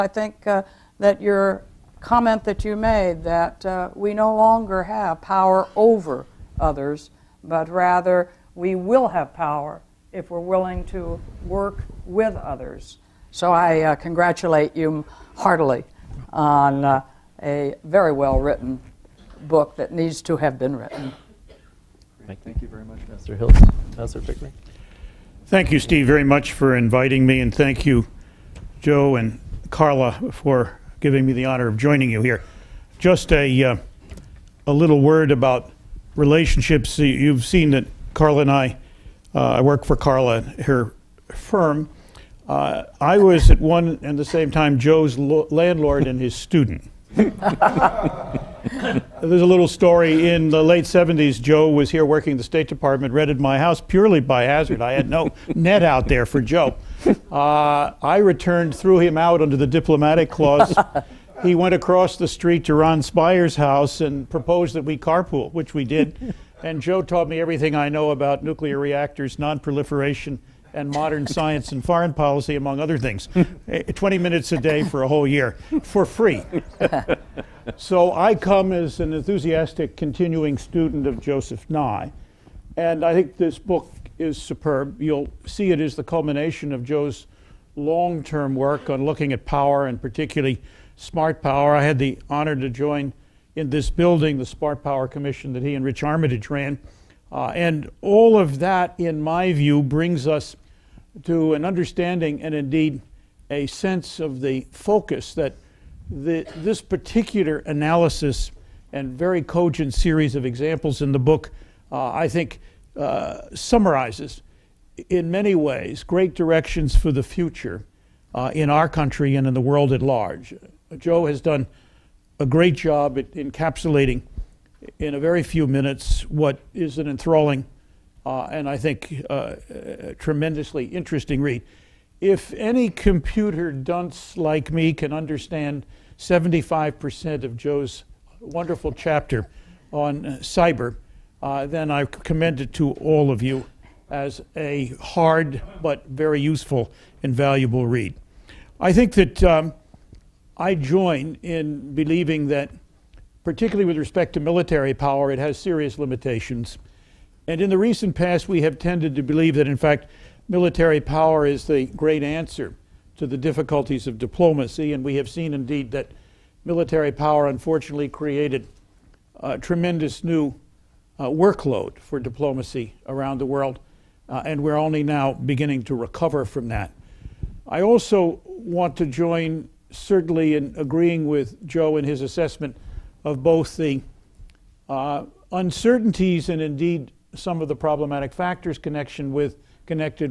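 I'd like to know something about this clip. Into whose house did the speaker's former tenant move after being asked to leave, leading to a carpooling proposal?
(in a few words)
Ron Spire.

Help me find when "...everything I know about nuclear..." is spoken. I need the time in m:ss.
1:07.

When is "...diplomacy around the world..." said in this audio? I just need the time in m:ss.
2:52.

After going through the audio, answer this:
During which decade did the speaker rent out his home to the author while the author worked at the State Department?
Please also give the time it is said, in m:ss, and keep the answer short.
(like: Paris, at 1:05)
late 70s, at 0:50.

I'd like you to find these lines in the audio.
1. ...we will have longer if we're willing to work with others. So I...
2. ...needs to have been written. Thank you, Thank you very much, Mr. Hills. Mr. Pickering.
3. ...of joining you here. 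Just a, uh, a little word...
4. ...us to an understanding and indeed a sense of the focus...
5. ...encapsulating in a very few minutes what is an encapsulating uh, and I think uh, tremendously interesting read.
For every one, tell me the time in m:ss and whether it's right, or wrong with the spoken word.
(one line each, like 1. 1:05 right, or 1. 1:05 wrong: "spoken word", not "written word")
1. 0:08 wrong: "power", not "longer"
2. 0:19 right
3. 0:31 right
4. 1:40 right
5. 2:03 wrong: "enthralling", not "encapsulating".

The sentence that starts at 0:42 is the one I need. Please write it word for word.
Uh, I was at one and the same time Joe's landlord and his student.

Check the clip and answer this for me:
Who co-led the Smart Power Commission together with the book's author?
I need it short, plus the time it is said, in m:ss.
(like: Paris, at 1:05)
Rich Armitage, at 1:35.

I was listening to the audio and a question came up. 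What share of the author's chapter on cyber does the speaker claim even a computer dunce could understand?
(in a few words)
75%.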